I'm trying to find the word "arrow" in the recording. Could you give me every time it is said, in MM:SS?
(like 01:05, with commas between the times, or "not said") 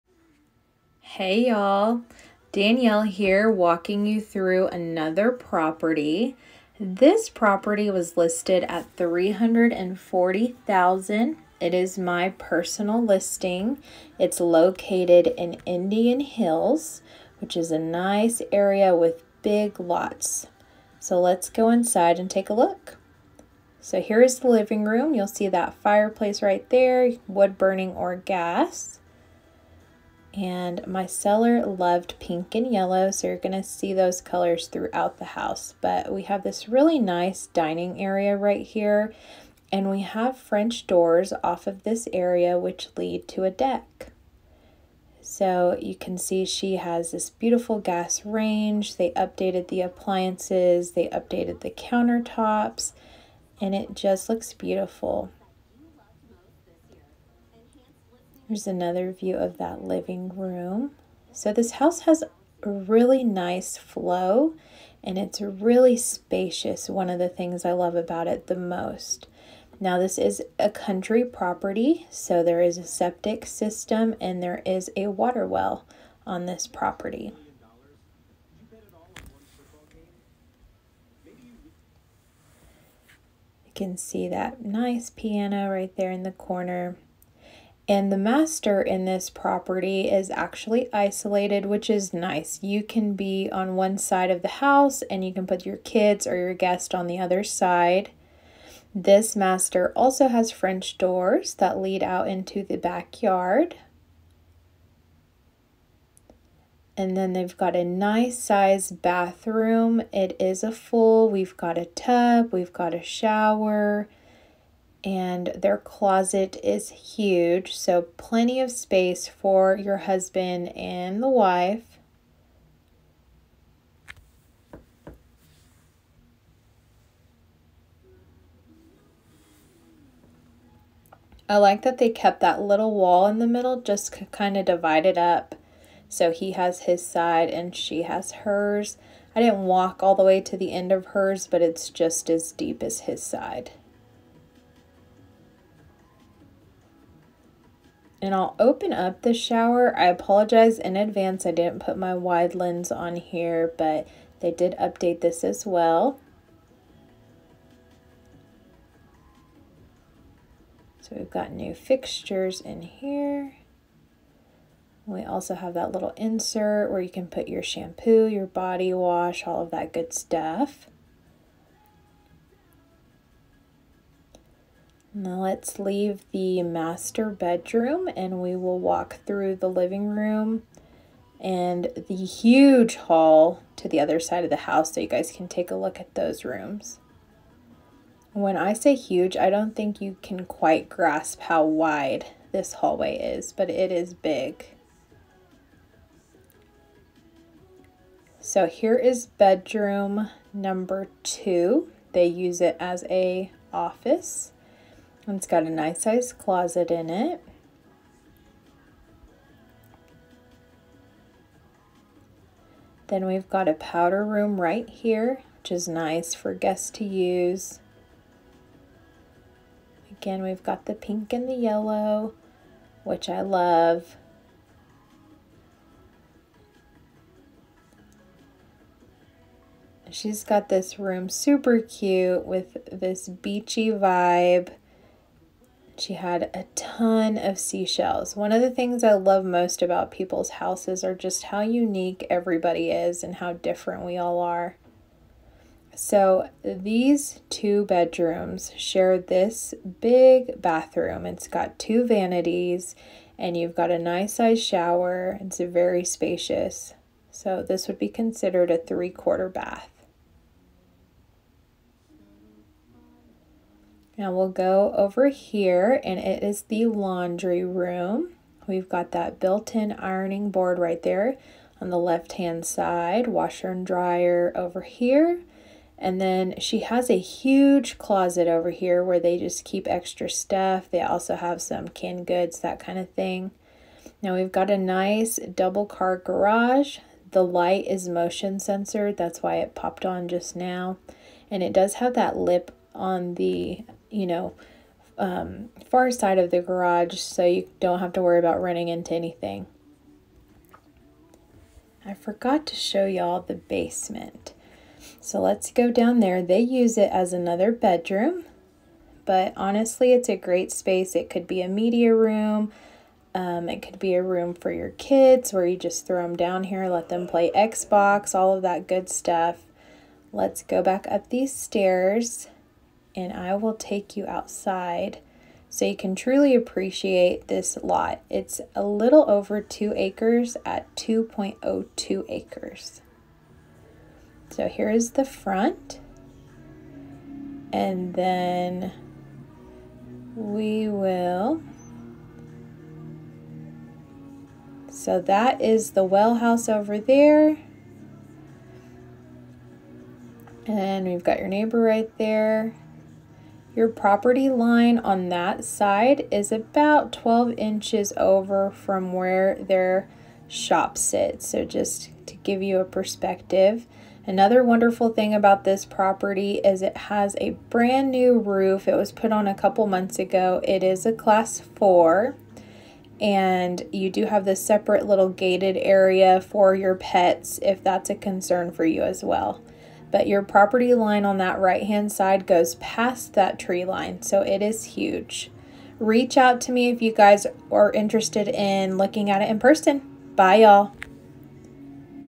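not said.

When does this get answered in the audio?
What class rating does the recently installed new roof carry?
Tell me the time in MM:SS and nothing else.
06:11.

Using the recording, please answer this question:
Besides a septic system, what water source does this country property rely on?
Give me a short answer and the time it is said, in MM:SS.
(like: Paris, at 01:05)
Water well, at 01:15.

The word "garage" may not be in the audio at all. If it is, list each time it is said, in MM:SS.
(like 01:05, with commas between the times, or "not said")
04:46, 04:56.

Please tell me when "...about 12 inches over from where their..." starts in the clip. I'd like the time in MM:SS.
05:56.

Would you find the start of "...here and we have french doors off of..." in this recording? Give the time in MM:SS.
00:38.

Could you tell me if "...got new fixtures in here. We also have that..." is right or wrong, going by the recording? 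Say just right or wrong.
right.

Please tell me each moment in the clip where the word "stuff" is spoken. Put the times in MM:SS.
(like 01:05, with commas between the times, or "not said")
02:50, 04:40, 05:19.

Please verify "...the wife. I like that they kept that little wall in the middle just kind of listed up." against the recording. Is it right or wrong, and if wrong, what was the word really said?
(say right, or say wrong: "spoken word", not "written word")
wrong: "divided", not "listed".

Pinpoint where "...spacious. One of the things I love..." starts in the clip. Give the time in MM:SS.
01:05.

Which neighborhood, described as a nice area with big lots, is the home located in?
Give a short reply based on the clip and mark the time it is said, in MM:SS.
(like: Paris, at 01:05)
Indian Hills, at 00:15.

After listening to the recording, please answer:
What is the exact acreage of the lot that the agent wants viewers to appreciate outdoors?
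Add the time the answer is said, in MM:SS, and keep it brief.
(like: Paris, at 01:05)
2.02 acres, at 05:30.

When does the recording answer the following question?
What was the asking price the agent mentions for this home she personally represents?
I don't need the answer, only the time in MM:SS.
00:08.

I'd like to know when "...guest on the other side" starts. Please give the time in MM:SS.
01:36.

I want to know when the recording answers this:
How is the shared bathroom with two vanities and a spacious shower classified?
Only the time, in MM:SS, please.
04:18.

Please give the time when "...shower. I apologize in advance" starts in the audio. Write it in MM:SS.
02:29.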